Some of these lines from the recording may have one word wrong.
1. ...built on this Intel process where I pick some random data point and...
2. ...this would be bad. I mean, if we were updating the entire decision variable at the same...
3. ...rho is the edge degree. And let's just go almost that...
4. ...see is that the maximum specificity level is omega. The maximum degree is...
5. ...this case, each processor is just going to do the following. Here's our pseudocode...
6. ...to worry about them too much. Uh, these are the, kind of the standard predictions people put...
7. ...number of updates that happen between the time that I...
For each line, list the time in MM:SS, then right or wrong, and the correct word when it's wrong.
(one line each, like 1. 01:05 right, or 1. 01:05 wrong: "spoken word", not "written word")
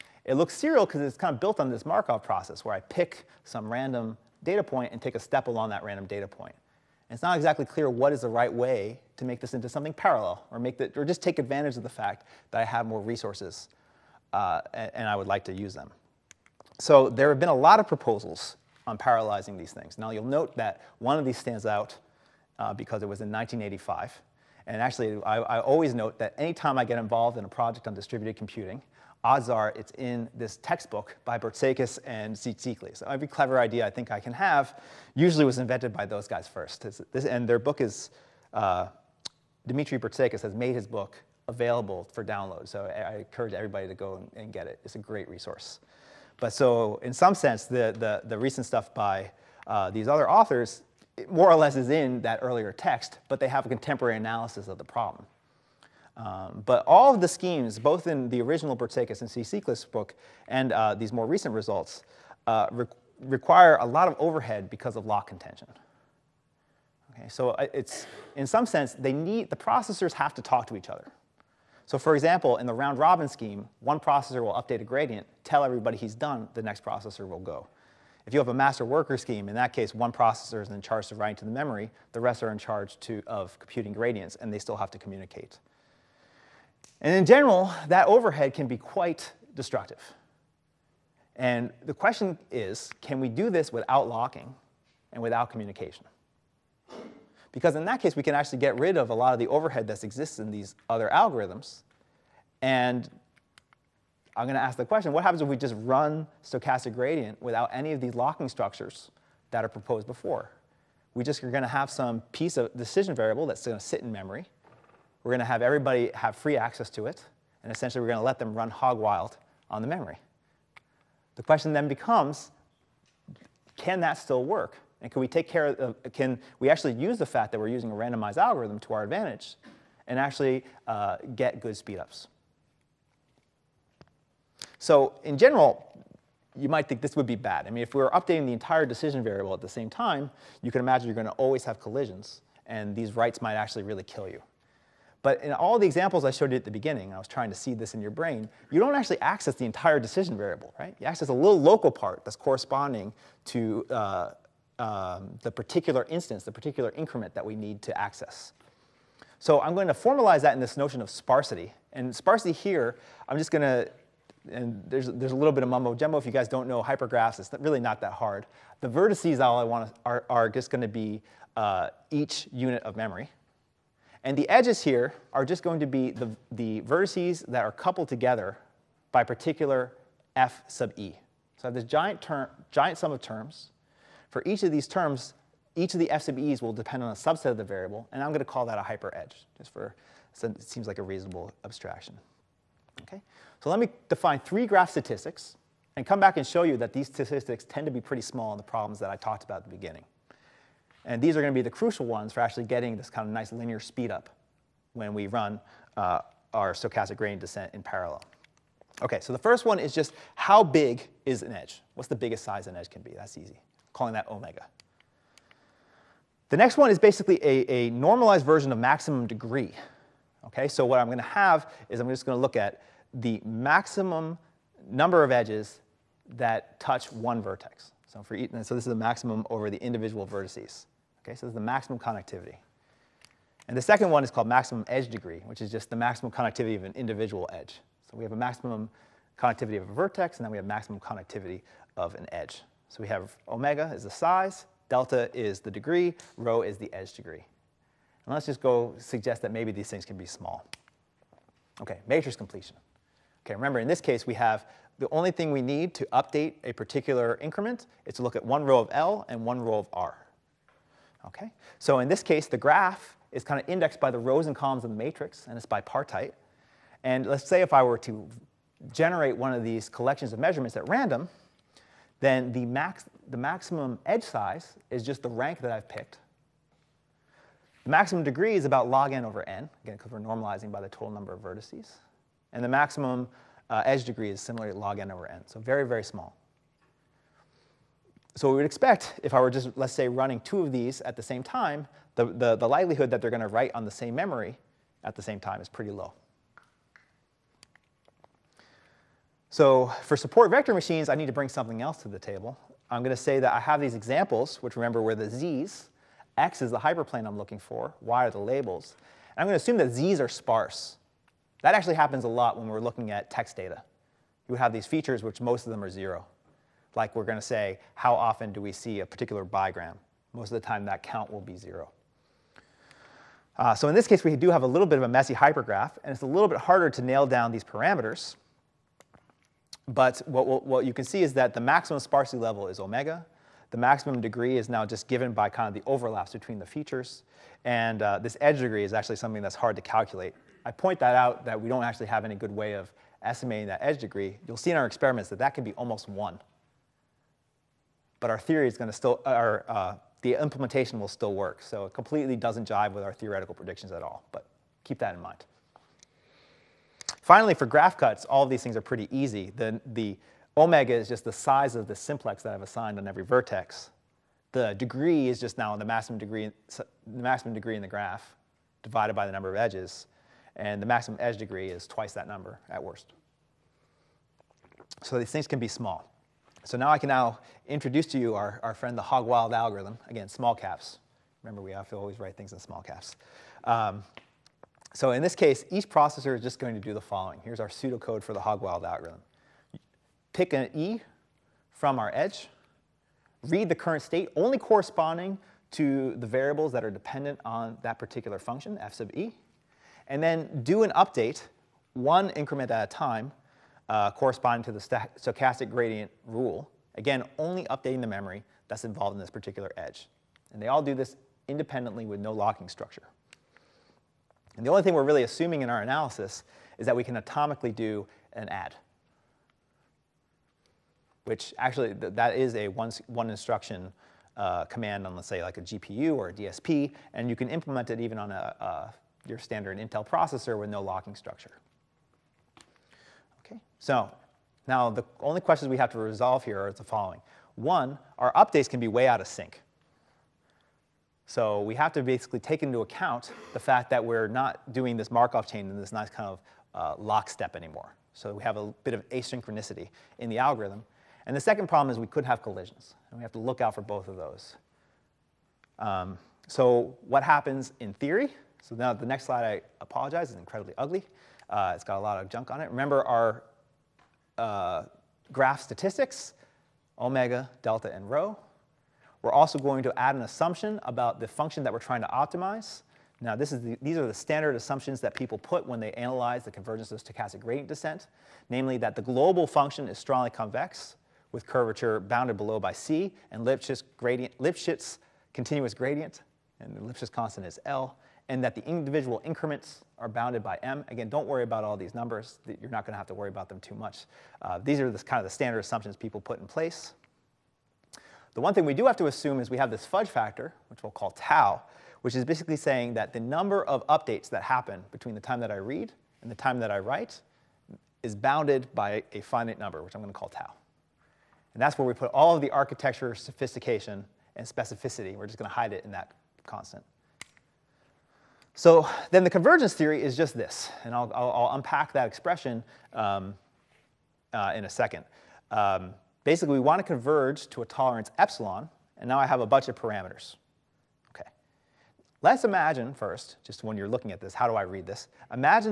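1. 00:01 wrong: "Markov", not "Intel"
2. 02:17 right
3. 04:06 wrong: "suggest", not "almost"
4. 05:31 wrong: "sparsity", not "specificity"
5. 06:25 right
6. 08:13 wrong: "assumptions", not "predictions"
7. 08:23 right.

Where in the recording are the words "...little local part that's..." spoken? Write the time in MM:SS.
02:31.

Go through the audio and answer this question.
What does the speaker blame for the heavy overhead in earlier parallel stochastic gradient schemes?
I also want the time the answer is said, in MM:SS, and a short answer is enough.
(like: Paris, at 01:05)
Lock contention, at 01:05.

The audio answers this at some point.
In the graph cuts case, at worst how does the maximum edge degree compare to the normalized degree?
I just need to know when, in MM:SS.
06:11.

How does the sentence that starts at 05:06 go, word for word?
X is the hyperplane I'm looking for.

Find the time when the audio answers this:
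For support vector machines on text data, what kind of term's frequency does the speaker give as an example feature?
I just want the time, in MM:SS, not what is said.
05:19.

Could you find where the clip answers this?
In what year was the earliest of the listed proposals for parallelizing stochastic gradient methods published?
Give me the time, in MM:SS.
00:23.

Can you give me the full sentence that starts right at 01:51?
We just are going to have some piece of decision variable that's going to sit in memory.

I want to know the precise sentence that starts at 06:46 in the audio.
Again, only updating the memory that's involved in this particular edge.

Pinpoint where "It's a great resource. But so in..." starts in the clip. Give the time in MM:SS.
00:44.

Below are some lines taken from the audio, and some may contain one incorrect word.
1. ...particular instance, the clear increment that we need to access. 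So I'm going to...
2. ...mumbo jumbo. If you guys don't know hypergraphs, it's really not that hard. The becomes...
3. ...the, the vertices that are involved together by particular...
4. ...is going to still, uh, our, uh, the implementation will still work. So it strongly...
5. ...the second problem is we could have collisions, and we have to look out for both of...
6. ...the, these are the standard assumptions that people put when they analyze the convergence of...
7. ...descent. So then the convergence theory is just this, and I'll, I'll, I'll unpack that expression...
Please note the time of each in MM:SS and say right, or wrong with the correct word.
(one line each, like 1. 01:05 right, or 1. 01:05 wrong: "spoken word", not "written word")
1. 02:35 wrong: "particular", not "clear"
2. 02:45 wrong: "vertices", not "becomes"
3. 02:56 wrong: "coupled", not "involved"
4. 05:48 wrong: "completely", not "strongly"
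5. 07:31 right
6. 07:53 right
7. 08:36 wrong: "constant", not "descent".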